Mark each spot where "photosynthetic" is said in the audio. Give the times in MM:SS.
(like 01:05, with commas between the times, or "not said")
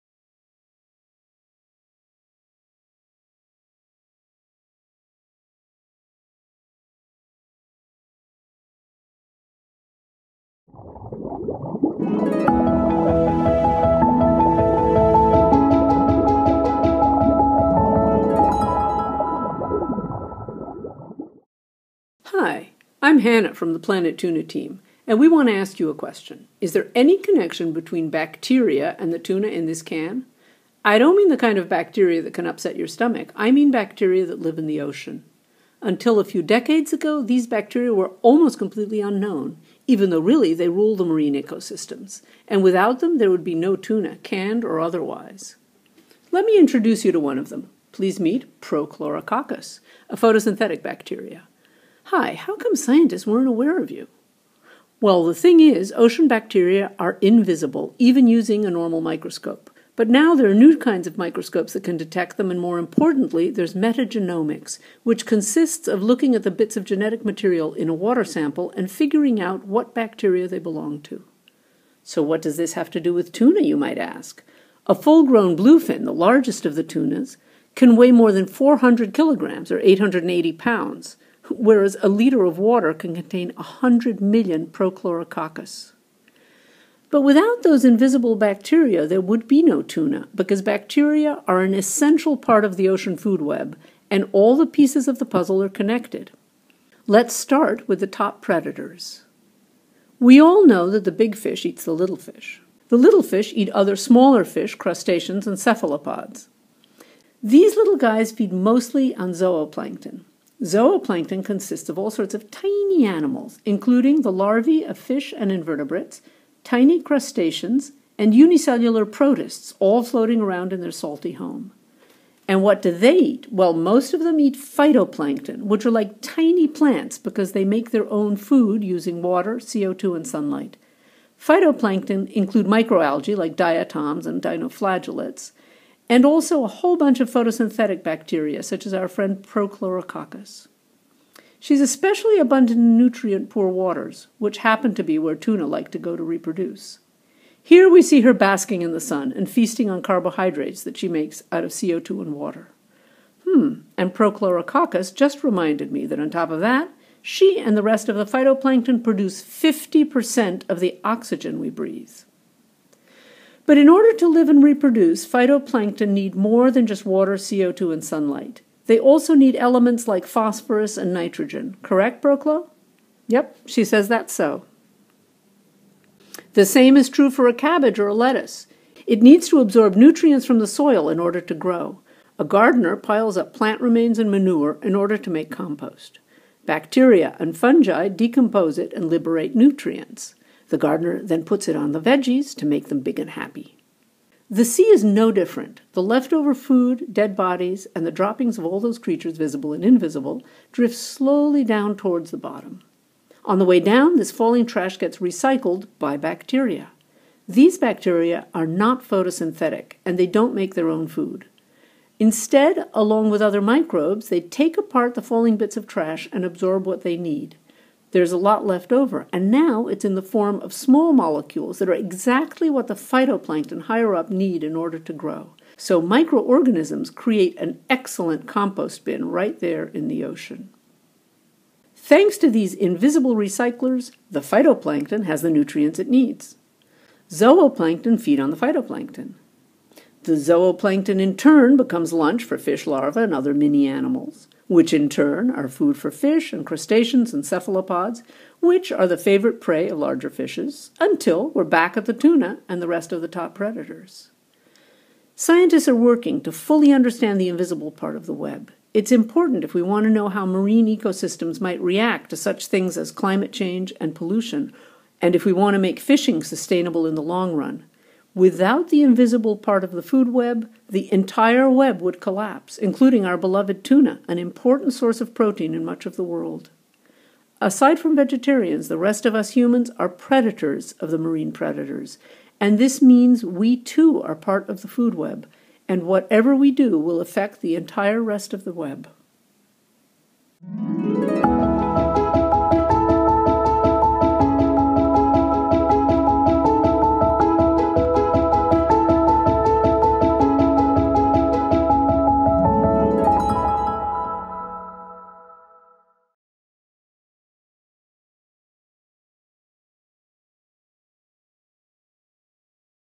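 00:50, 02:17, 03:29.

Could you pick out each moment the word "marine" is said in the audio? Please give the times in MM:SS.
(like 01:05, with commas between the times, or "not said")
00:41, 04:20, 04:41.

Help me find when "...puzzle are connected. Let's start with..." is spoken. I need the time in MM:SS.
01:35.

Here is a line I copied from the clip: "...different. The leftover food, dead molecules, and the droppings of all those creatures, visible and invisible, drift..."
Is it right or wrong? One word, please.
wrong.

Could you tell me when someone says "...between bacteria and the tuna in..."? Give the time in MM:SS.
00:27.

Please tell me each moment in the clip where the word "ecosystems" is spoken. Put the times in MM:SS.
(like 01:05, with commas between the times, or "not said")
00:41, 04:20.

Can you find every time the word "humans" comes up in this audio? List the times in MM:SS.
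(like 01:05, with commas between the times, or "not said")
04:39.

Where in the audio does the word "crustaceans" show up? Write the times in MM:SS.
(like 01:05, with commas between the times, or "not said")
01:44, 01:57, 04:06.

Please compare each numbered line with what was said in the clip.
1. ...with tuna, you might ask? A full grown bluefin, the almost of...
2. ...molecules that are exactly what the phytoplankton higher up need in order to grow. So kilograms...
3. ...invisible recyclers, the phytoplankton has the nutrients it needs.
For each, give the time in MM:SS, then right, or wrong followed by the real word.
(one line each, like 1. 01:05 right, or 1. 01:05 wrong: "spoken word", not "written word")
1. 01:13 wrong: "largest", not "almost"
2. 03:41 wrong: "microorganisms", not "kilograms"
3. 03:52 right.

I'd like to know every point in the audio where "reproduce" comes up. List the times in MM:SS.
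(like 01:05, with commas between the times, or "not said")
02:26, 02:44.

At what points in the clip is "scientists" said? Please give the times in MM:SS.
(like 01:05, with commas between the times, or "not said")
00:52, 04:15.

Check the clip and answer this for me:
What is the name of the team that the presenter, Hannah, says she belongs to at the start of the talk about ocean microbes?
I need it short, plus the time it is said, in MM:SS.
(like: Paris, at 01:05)
Planet Tuna, at 00:23.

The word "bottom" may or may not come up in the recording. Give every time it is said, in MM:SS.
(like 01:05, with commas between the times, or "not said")
03:22.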